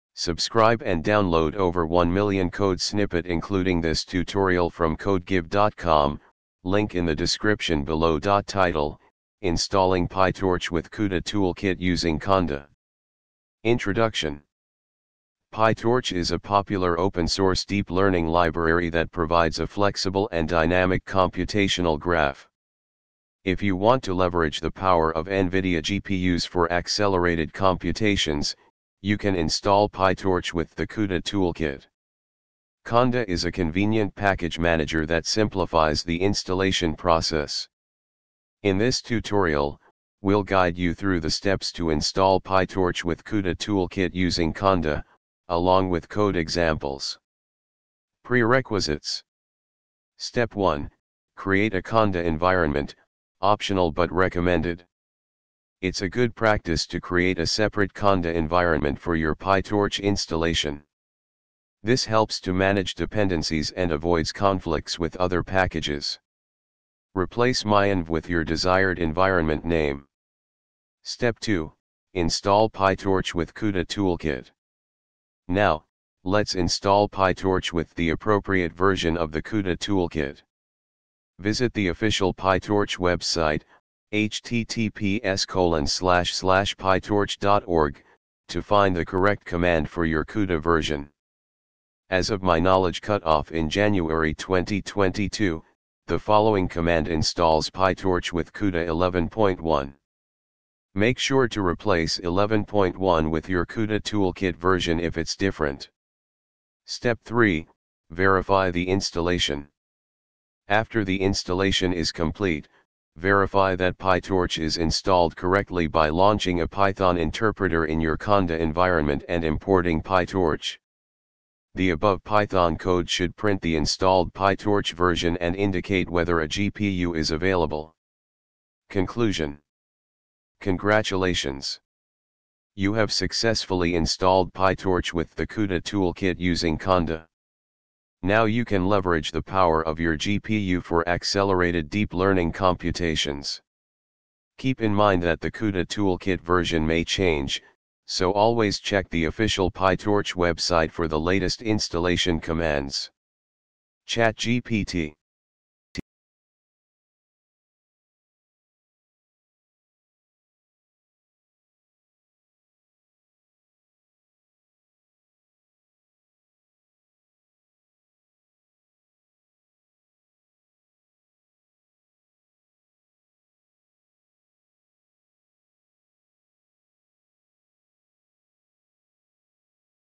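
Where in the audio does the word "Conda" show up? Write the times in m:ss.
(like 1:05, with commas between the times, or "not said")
0:12, 0:32, 0:44, 0:51, 0:57, 1:58, 2:16.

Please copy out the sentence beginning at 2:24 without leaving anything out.
Keep in mind that the CUDA toolkit version may change, so always check the official PyTorch website for the latest installation commands.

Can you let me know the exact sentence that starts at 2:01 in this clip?
The above Python code should print the installed PyTorch version and indicate whether a GPU is available.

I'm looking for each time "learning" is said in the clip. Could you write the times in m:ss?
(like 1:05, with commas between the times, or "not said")
0:17, 2:22.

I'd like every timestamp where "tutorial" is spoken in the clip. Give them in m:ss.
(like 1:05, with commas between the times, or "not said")
0:04, 0:39.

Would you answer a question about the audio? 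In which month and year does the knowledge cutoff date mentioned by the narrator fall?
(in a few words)
January 2022.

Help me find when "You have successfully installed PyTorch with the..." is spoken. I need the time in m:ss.
2:12.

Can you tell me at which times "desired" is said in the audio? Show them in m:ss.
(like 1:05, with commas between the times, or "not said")
1:08.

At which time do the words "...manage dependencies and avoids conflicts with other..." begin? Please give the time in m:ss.
1:02.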